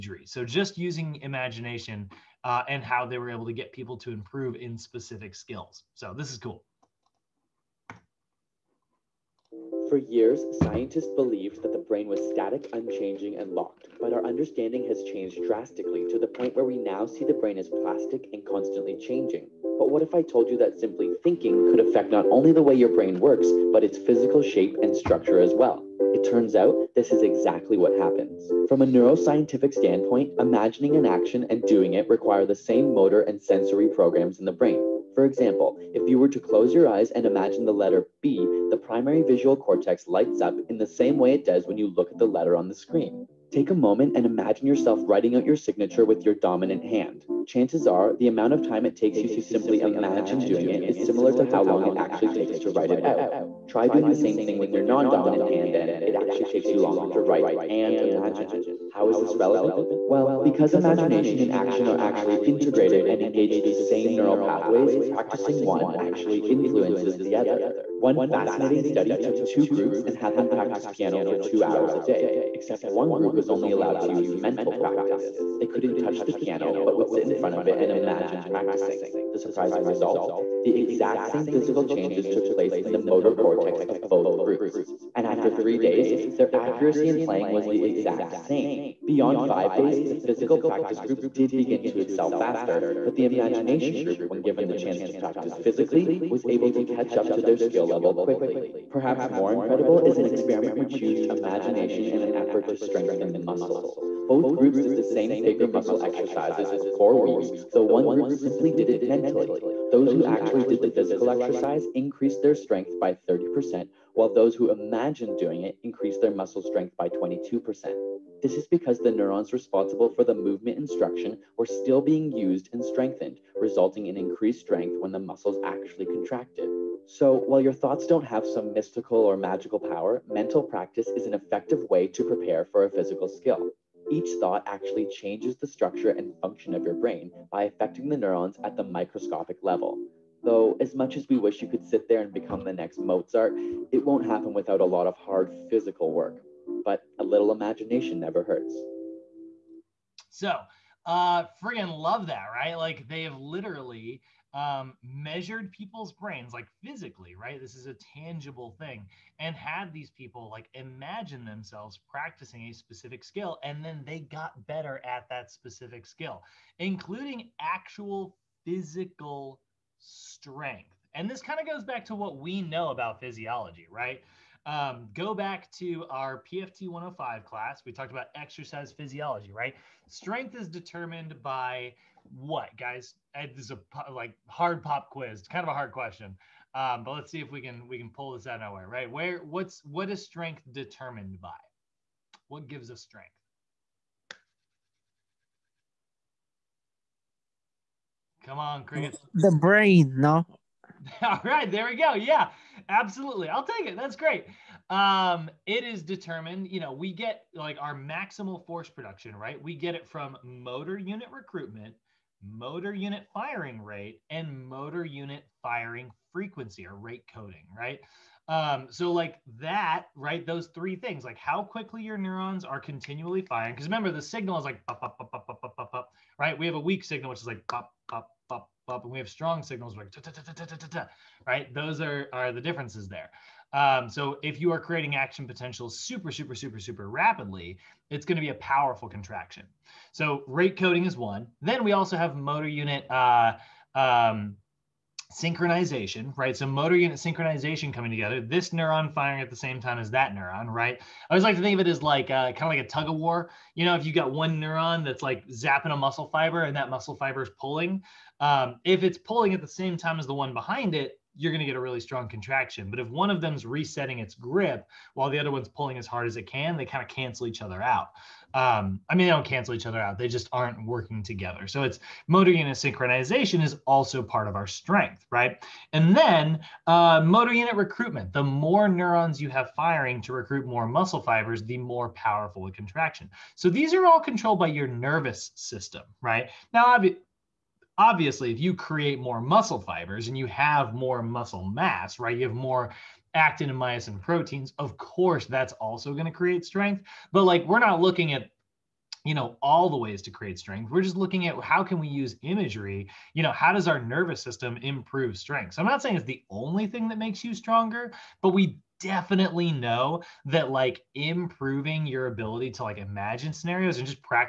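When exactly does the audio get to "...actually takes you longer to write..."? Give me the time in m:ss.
0:56.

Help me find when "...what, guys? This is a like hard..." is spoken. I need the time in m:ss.
3:02.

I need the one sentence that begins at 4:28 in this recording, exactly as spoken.
Um, I mean, they don't cancel each other out.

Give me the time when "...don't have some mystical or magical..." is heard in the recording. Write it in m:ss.
2:08.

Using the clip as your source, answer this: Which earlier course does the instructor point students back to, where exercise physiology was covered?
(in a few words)
PFT 105.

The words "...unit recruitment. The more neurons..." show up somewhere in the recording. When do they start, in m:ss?
4:37.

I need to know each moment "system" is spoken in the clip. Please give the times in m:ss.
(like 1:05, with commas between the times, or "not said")
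4:45, 5:04.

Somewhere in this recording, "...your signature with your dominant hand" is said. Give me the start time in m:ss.
0:45.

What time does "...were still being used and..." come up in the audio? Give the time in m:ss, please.
2:01.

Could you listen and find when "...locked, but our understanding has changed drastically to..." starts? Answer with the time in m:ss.
0:13.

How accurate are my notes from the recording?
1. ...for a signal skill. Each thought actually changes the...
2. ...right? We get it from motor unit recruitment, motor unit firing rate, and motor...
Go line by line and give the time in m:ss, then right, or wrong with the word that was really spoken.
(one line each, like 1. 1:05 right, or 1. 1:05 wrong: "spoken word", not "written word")
1. 2:12 wrong: "physical", not "signal"
2. 3:29 right.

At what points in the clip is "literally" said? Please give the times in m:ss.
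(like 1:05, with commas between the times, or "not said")
2:33.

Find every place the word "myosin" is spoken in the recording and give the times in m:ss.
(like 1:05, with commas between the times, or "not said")
4:53.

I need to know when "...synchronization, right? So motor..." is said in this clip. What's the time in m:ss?
4:05.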